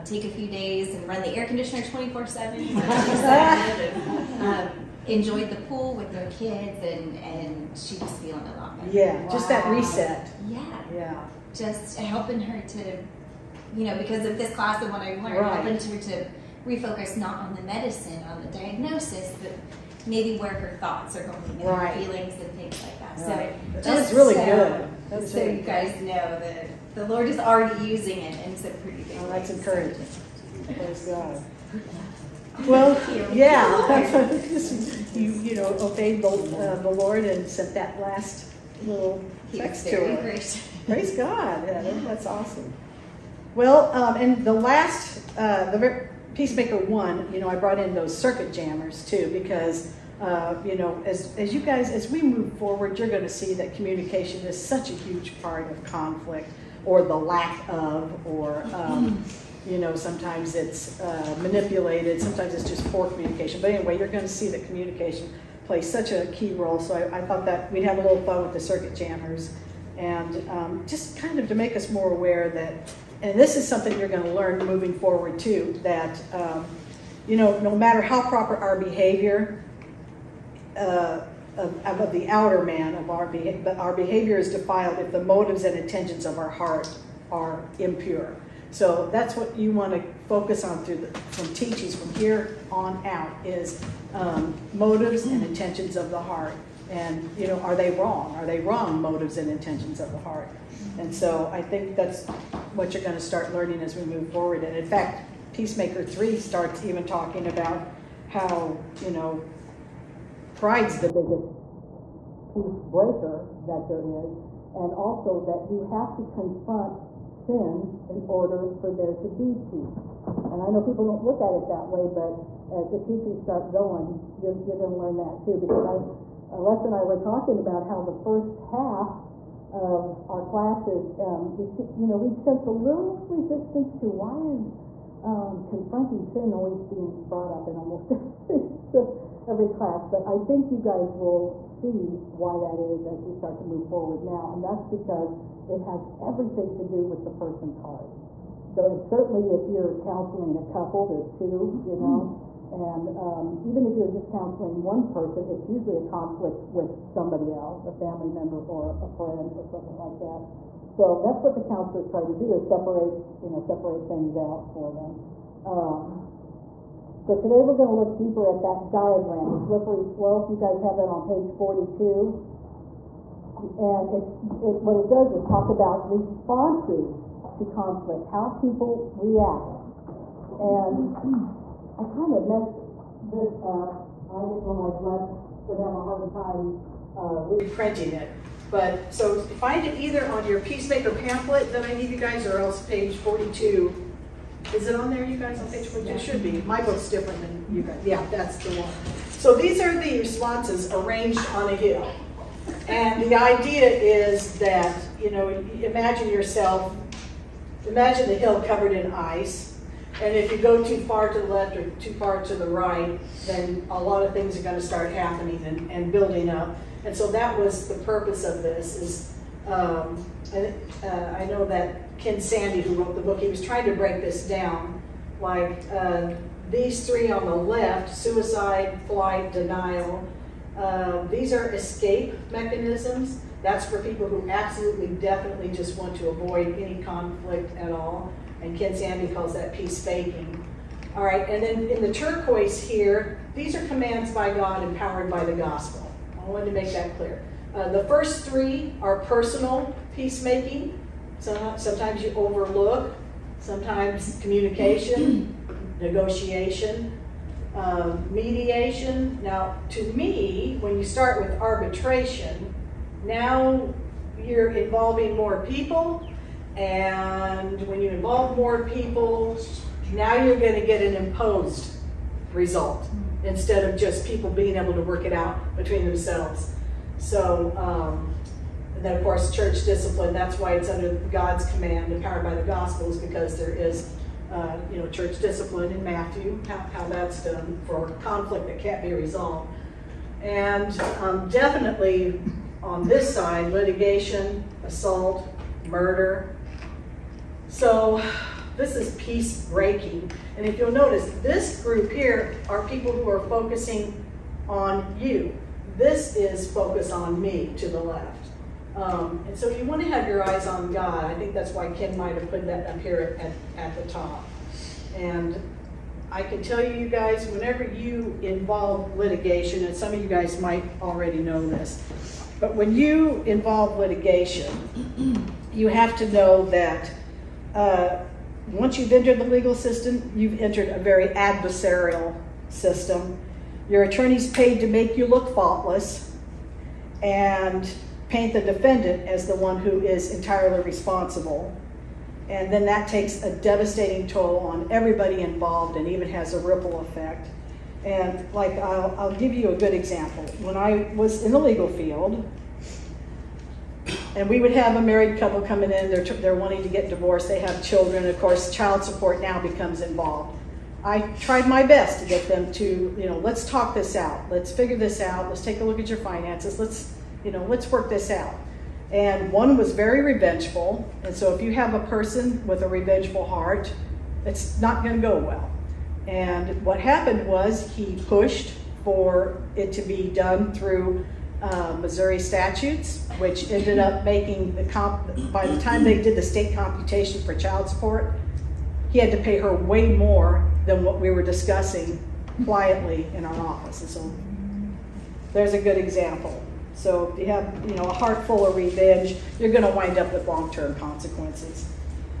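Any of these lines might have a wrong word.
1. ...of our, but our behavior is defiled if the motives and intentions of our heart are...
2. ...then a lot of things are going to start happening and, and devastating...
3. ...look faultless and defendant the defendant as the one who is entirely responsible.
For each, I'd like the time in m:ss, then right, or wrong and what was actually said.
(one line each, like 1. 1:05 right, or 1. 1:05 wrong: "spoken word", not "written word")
1. 1:22 right
2. 3:33 wrong: "building", not "devastating"
3. 5:35 wrong: "paint", not "defendant".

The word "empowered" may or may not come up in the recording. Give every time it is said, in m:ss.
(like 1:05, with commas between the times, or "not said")
4:04, 4:42.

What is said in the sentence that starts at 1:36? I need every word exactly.
And, you know, are they wrong?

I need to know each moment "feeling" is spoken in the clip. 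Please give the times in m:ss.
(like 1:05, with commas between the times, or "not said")
0:08, 0:21.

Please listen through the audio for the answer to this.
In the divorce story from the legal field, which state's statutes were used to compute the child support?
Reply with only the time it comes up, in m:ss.
6:22.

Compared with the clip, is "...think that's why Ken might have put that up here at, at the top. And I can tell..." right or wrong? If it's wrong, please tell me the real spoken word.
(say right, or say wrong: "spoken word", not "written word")
right.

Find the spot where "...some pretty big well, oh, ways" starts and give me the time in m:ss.
0:28.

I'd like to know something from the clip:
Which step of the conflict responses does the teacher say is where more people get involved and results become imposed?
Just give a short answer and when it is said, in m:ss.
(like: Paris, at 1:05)
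arbitration, at 4:21.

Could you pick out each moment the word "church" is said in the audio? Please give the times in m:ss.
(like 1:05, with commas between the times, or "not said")
4:39, 4:45.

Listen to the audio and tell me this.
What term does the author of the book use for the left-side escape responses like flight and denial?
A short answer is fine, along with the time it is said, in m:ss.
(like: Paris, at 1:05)
peace faking, at 3:59.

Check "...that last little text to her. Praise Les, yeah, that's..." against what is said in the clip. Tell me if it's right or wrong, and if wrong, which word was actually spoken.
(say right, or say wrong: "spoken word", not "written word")
wrong: "God", not "Les".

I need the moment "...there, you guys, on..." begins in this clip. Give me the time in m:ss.
3:15.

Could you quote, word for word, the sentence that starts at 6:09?
And one was very revengeful, and so if you have a person with a revengeful heart, it's not going to go well.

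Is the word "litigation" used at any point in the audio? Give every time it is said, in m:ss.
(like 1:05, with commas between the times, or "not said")
4:53, 5:19, 5:23.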